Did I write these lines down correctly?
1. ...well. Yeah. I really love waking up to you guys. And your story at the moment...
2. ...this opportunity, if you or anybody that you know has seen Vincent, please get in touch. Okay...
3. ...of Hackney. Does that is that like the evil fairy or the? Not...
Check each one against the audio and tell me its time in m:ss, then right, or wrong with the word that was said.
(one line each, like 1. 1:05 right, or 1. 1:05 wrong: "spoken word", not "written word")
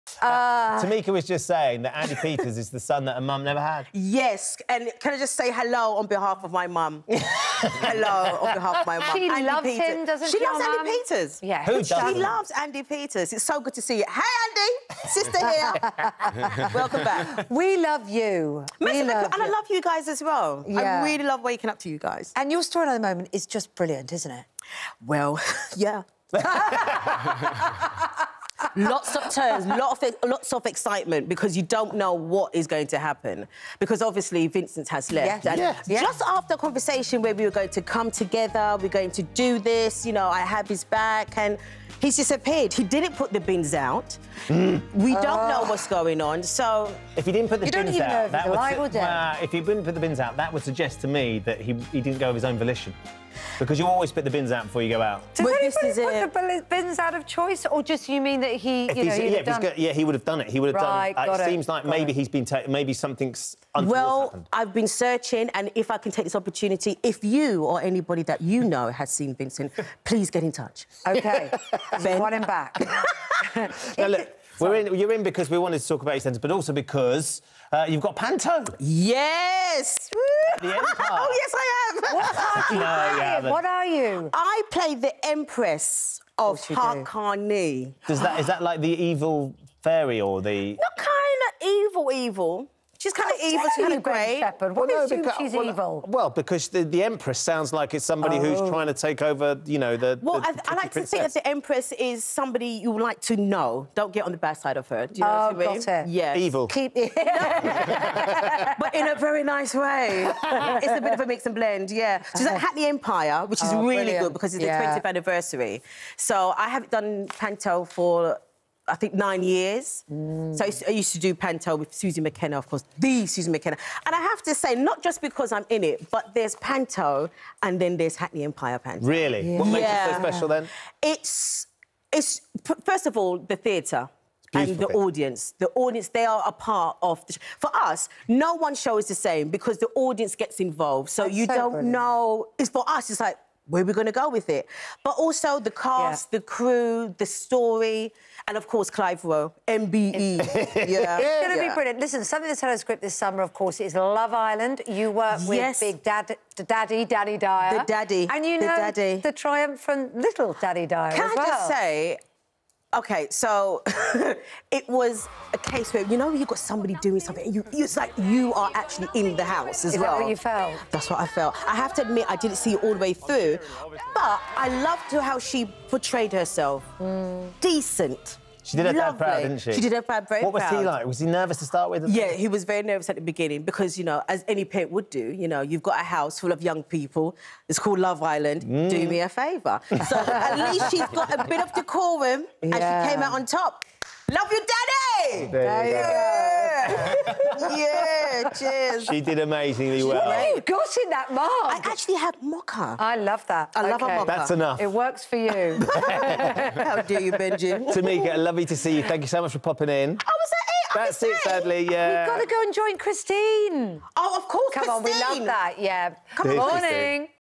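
1. 0:20 right
2. 1:06 right
3. 1:26 right.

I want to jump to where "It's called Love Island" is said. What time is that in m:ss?
3:07.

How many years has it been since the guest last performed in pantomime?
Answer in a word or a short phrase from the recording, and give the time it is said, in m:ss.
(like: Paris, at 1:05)
9, at 1:59.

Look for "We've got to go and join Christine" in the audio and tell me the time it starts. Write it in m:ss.
3:32.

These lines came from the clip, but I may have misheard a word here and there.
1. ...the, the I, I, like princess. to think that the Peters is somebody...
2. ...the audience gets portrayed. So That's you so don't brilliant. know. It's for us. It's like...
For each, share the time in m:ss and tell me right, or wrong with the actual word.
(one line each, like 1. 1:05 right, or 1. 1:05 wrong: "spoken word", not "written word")
1. 1:40 wrong: "Empress", not "Peters"
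2. 2:19 wrong: "involved", not "portrayed".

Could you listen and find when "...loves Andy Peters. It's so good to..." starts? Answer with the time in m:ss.
0:12.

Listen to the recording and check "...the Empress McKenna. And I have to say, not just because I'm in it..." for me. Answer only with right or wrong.
wrong.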